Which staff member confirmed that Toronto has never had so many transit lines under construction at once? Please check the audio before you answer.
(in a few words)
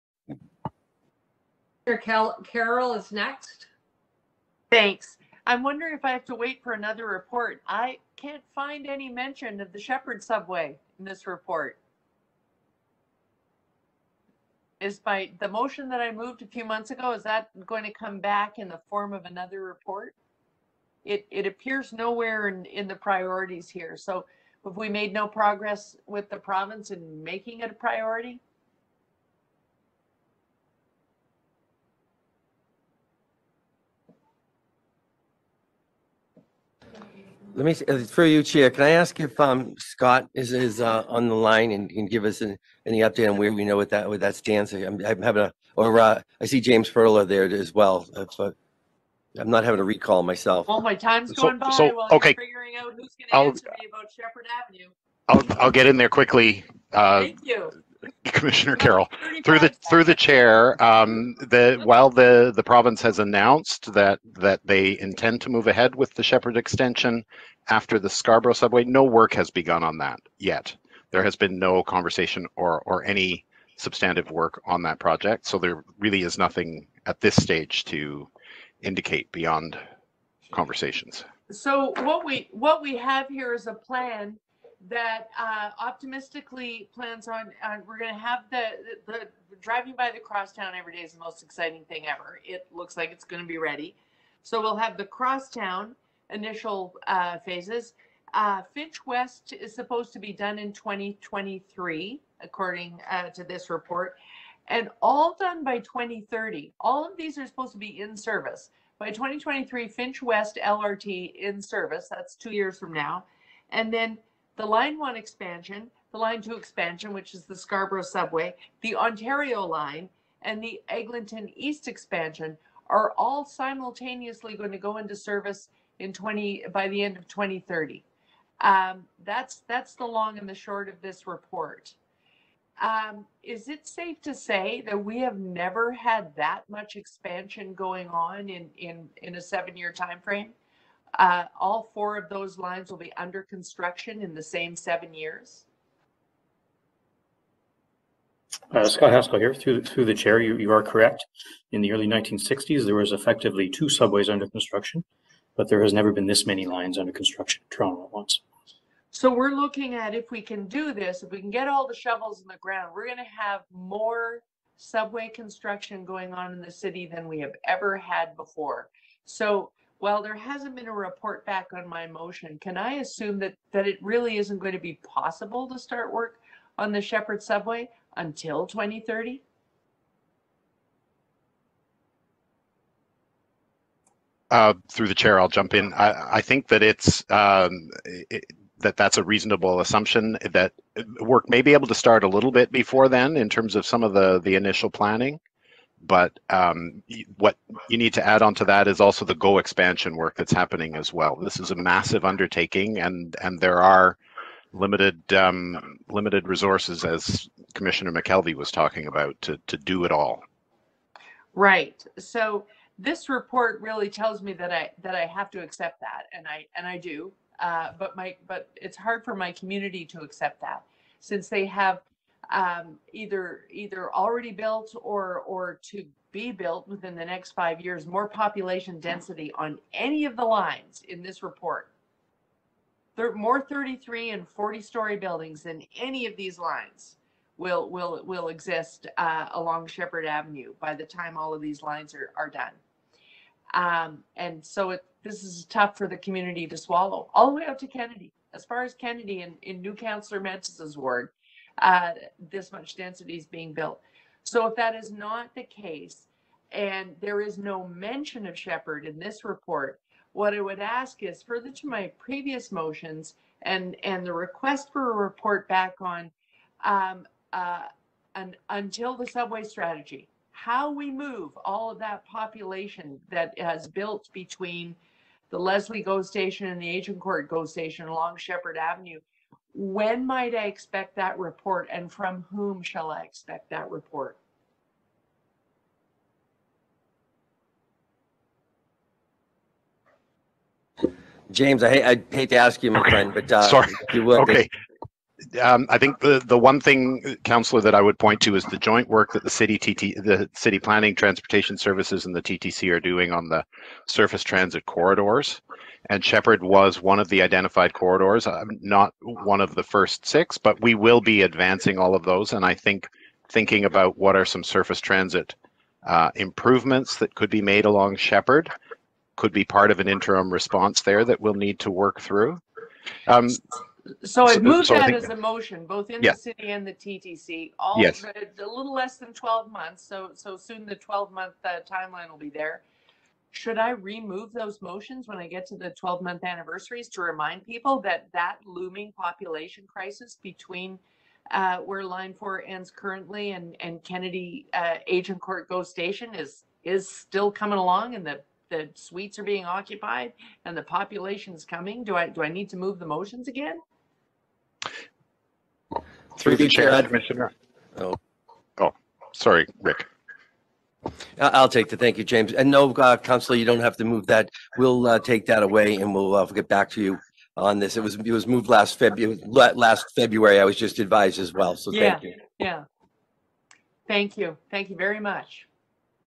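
Scott Haskill.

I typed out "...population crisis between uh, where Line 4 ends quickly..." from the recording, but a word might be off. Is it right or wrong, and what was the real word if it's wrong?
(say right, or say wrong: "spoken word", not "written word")
wrong: "currently", not "quickly".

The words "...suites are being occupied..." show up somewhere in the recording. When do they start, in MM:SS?
05:48.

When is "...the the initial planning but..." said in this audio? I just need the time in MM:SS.
03:14.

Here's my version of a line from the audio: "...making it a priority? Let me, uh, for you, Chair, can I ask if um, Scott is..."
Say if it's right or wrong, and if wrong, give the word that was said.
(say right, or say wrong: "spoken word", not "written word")
right.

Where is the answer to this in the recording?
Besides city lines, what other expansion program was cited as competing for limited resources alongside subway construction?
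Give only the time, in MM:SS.
03:19.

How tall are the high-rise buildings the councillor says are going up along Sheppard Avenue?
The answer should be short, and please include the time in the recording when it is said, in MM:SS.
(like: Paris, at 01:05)
33 and 40 stories, at 03:53.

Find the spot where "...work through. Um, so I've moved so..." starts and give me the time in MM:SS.
05:21.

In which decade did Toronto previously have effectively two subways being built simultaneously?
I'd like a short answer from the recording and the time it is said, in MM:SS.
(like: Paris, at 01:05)
early 1960s, at 02:31.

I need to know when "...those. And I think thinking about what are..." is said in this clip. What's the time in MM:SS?
05:12.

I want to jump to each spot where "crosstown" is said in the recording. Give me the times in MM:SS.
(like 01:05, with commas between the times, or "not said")
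01:30, 01:35.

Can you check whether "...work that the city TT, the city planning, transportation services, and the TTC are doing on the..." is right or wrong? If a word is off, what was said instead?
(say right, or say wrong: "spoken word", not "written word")
right.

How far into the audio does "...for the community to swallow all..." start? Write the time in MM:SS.
04:05.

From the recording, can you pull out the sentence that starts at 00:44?
I'm I'm having a, or uh, I see James Furler there as well.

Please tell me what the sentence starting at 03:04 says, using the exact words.
Uh, through the chair, I'll jump in.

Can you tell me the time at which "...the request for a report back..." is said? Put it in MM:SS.
04:24.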